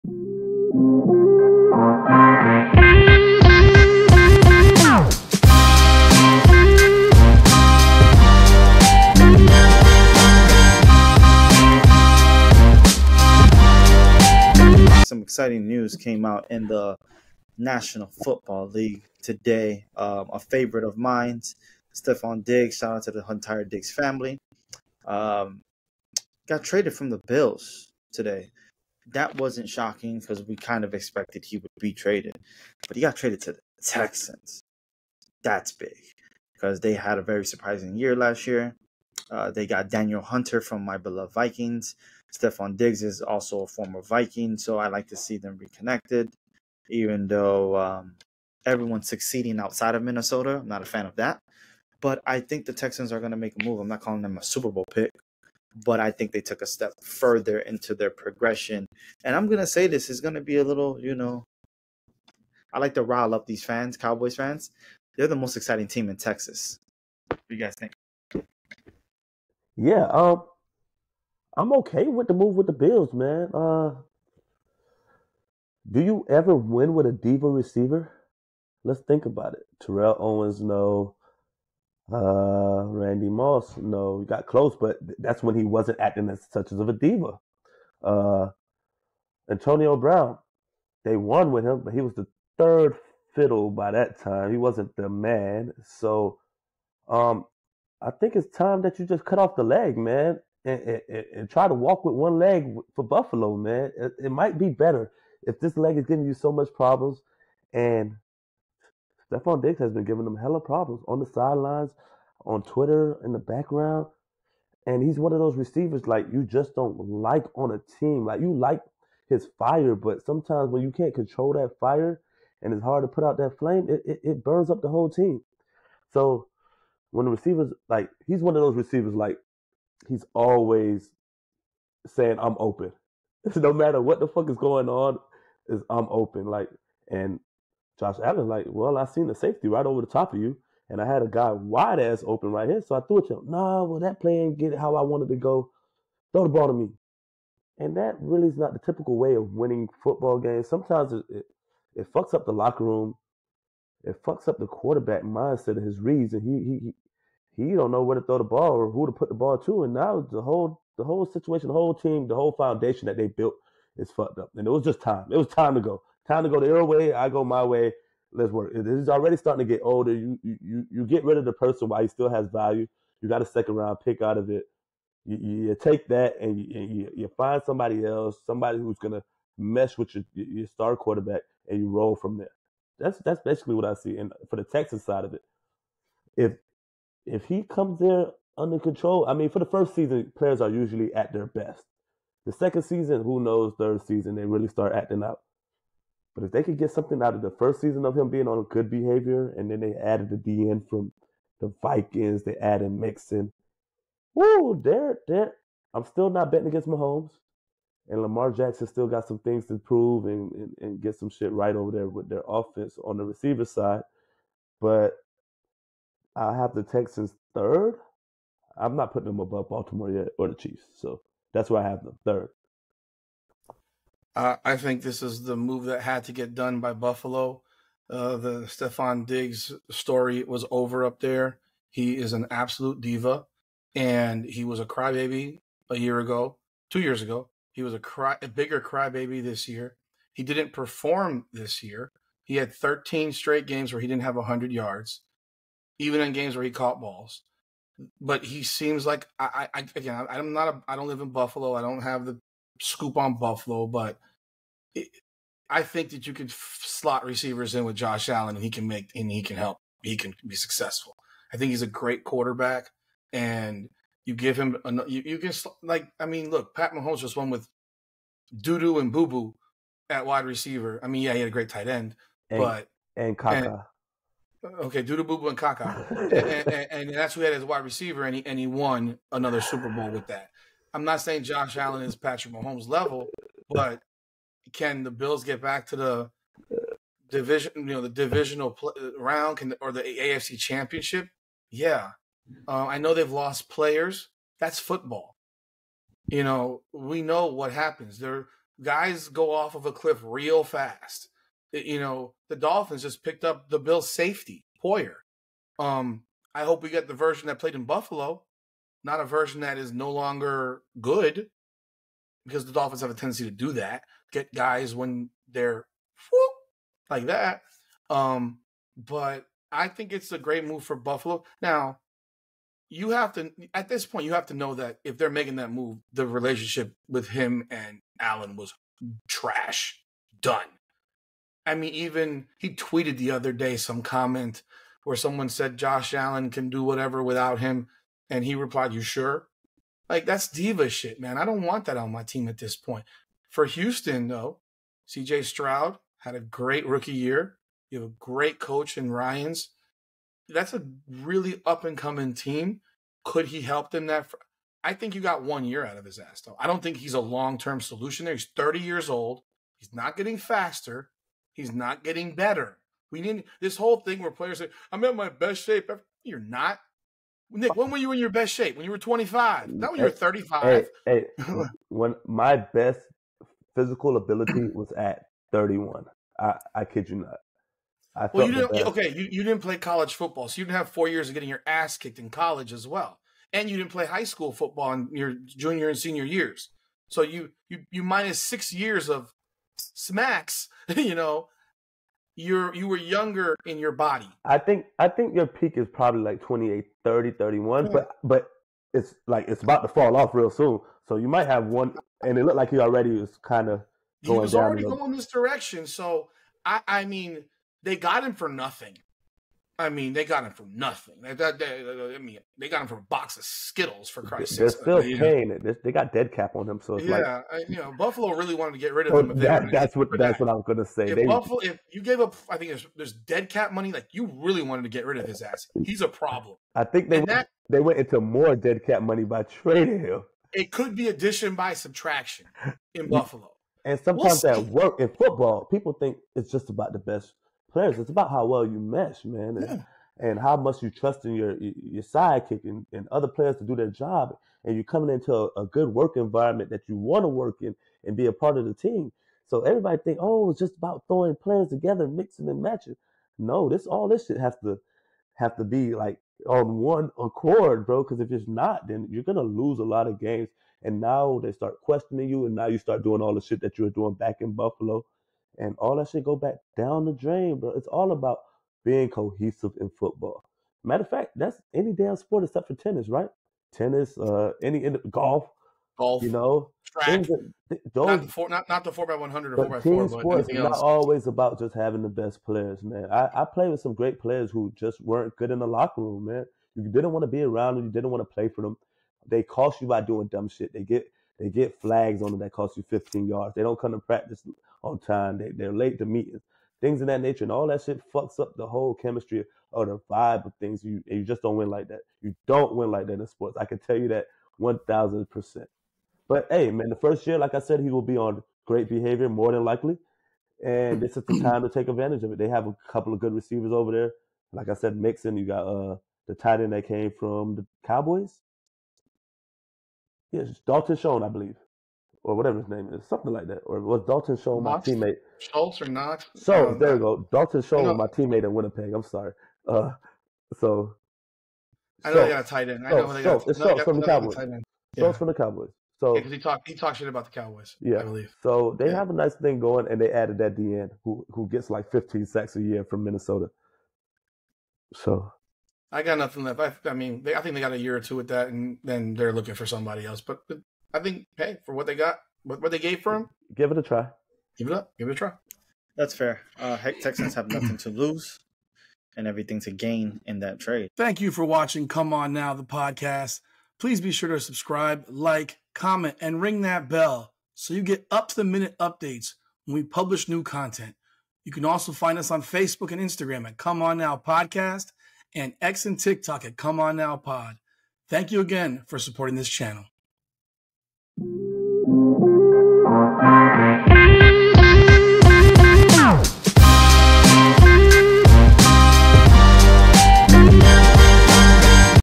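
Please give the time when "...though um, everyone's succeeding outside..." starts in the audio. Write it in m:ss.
0:47.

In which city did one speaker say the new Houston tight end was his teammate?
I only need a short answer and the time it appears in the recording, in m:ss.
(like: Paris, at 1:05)
Winnipeg, at 8:48.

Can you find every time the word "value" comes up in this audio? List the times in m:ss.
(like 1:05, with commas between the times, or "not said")
2:52.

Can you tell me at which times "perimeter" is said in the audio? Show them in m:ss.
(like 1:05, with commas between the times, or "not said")
not said.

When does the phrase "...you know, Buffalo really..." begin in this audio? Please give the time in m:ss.
6:57.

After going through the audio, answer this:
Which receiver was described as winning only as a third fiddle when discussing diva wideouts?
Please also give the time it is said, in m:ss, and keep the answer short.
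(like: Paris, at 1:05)
Antonio Brown, at 1:29.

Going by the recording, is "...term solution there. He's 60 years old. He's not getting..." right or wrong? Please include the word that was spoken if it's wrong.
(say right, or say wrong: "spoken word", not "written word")
wrong: "30", not "60".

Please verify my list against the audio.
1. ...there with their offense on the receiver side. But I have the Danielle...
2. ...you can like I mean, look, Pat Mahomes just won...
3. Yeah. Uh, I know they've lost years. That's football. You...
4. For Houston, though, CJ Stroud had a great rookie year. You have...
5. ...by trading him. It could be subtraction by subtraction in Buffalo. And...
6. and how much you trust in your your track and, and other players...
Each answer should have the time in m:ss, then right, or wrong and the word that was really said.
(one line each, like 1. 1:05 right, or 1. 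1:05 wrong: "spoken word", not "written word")
1. 3:31 wrong: "Texans", not "Danielle"
2. 4:25 right
3. 4:51 wrong: "players", not "years"
4. 5:43 right
5. 7:09 wrong: "addition", not "subtraction"
6. 7:20 wrong: "sidekick", not "track".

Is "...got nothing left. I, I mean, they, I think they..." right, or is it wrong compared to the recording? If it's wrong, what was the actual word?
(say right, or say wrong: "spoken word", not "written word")
right.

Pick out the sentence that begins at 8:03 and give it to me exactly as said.
I, I played with some great players who just weren't good in the locker room, man.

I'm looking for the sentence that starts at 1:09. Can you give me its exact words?
Yeah, um, I'm okay with the move with the Bills, man.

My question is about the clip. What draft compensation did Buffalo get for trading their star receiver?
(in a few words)
A second round pick.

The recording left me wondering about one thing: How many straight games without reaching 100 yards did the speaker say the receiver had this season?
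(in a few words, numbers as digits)
13.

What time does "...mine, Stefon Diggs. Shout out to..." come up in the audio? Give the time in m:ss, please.
0:20.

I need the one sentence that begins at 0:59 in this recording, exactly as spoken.
And I'm gonna say this is gonna be a little, you know, I like to rile up these fans, Cowboys fans.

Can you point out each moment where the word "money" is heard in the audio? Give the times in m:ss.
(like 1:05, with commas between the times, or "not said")
7:03, 7:09.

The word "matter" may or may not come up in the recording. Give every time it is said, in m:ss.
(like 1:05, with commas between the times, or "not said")
2:13, 7:50.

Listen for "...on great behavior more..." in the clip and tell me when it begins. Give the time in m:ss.
8:28.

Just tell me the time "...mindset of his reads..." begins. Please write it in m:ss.
2:35.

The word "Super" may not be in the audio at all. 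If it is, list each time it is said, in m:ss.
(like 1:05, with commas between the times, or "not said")
0:54, 4:39.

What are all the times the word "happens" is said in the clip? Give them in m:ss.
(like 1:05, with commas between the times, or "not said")
4:57.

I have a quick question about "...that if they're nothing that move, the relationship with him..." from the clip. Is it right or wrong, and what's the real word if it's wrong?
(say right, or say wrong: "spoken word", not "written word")
wrong: "making", not "nothing".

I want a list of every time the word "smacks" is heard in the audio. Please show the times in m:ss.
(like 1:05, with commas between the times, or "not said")
6:29.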